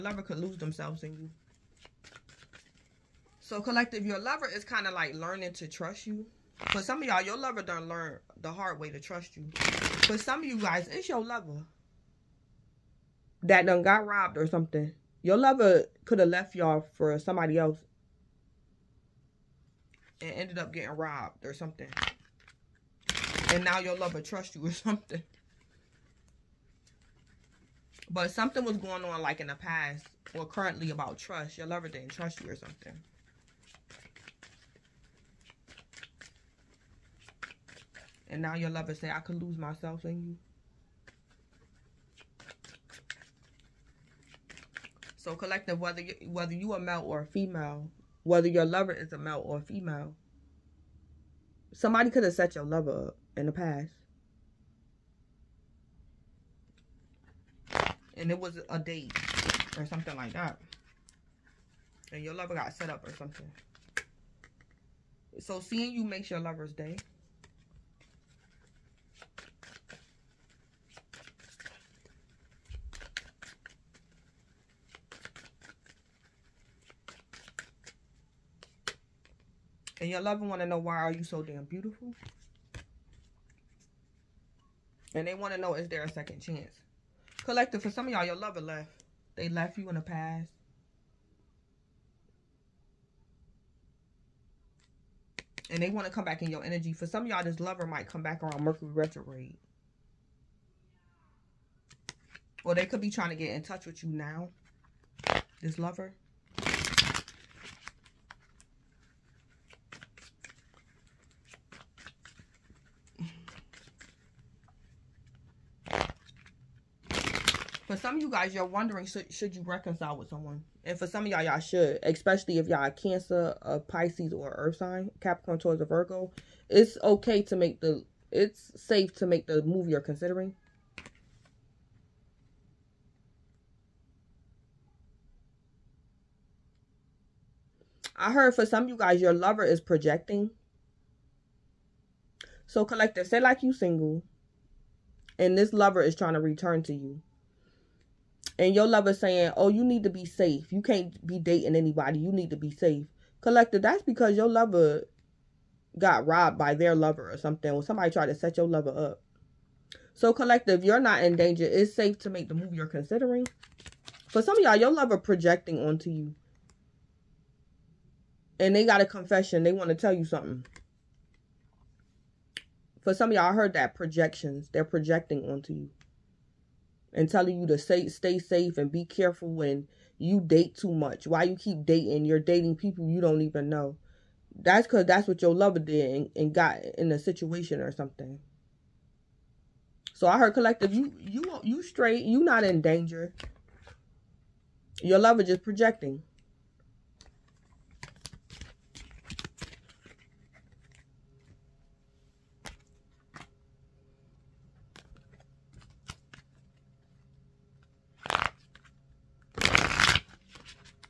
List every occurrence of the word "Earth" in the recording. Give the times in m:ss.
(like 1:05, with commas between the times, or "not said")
2:04.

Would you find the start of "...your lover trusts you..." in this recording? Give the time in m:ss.
0:23.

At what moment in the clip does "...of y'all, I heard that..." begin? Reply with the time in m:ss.
2:53.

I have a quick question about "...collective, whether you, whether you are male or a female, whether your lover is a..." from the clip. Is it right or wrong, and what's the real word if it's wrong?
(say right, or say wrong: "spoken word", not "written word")
right.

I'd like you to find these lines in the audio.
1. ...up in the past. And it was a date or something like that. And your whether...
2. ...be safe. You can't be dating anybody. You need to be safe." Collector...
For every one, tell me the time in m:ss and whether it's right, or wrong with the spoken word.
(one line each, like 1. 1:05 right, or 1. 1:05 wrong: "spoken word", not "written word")
1. 0:53 wrong: "lover", not "whether"
2. 2:30 right.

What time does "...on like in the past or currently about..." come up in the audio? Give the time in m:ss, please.
0:29.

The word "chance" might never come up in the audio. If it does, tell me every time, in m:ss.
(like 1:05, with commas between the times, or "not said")
1:26.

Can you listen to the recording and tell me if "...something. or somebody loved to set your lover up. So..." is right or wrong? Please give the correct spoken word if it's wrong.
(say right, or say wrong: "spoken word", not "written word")
wrong: "tried", not "loved".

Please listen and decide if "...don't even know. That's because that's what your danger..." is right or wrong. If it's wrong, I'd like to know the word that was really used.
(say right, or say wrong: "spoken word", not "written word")
wrong: "lover", not "danger".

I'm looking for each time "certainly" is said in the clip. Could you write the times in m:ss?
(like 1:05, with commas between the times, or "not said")
not said.